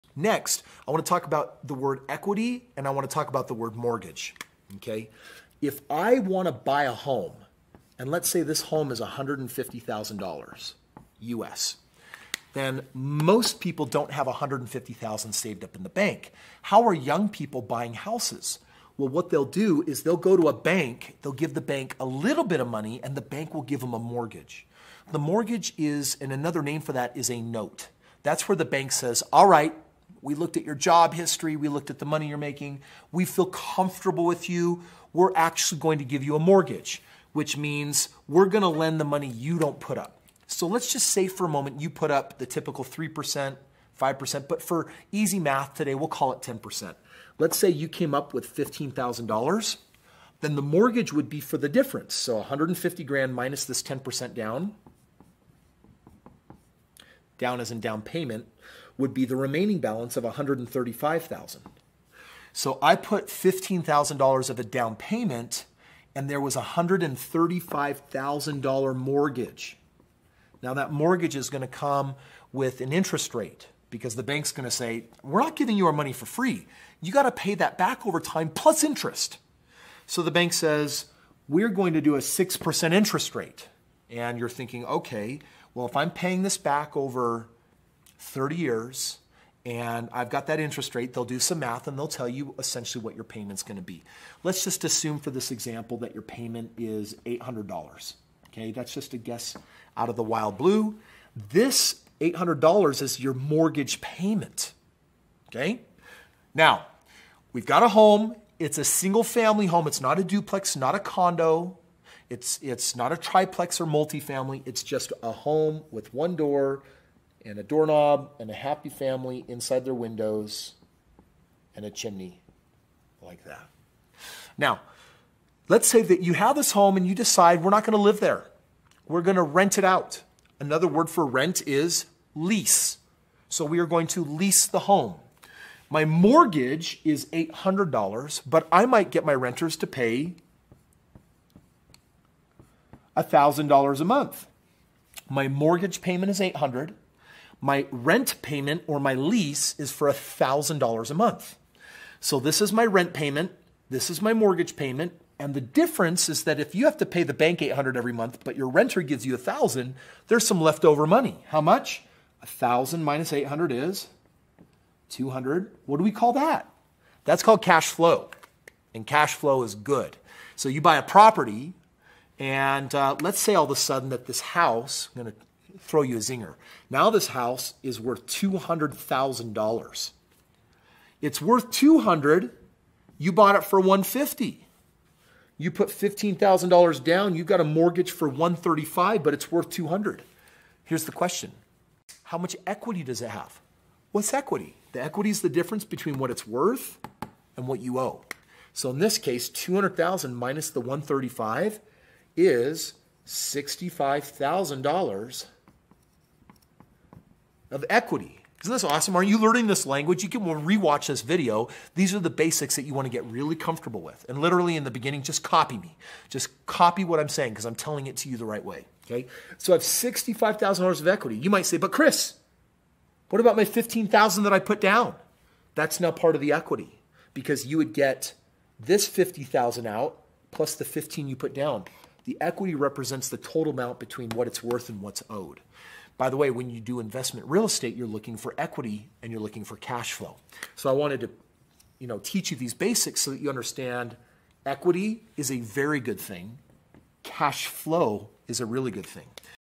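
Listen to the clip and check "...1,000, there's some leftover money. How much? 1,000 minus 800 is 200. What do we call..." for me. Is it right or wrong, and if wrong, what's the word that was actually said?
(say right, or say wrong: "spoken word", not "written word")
right.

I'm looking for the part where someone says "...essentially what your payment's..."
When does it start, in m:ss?
1:32.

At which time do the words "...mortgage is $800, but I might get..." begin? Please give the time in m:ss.
2:16.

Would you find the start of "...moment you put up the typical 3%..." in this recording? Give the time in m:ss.
0:41.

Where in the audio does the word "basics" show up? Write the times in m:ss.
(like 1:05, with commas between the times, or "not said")
3:32, 4:02.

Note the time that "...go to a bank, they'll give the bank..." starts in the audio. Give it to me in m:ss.
0:20.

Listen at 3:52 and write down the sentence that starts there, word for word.
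The equity represents the total amount between what it's worth and what's owed.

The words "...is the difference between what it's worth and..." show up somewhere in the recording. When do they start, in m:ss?
3:15.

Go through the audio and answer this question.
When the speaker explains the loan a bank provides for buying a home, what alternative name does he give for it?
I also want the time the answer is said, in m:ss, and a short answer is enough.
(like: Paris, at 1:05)
note, at 0:27.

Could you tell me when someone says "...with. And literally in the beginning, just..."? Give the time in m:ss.
3:34.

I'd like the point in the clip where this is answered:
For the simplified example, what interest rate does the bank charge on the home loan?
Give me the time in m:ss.
1:22.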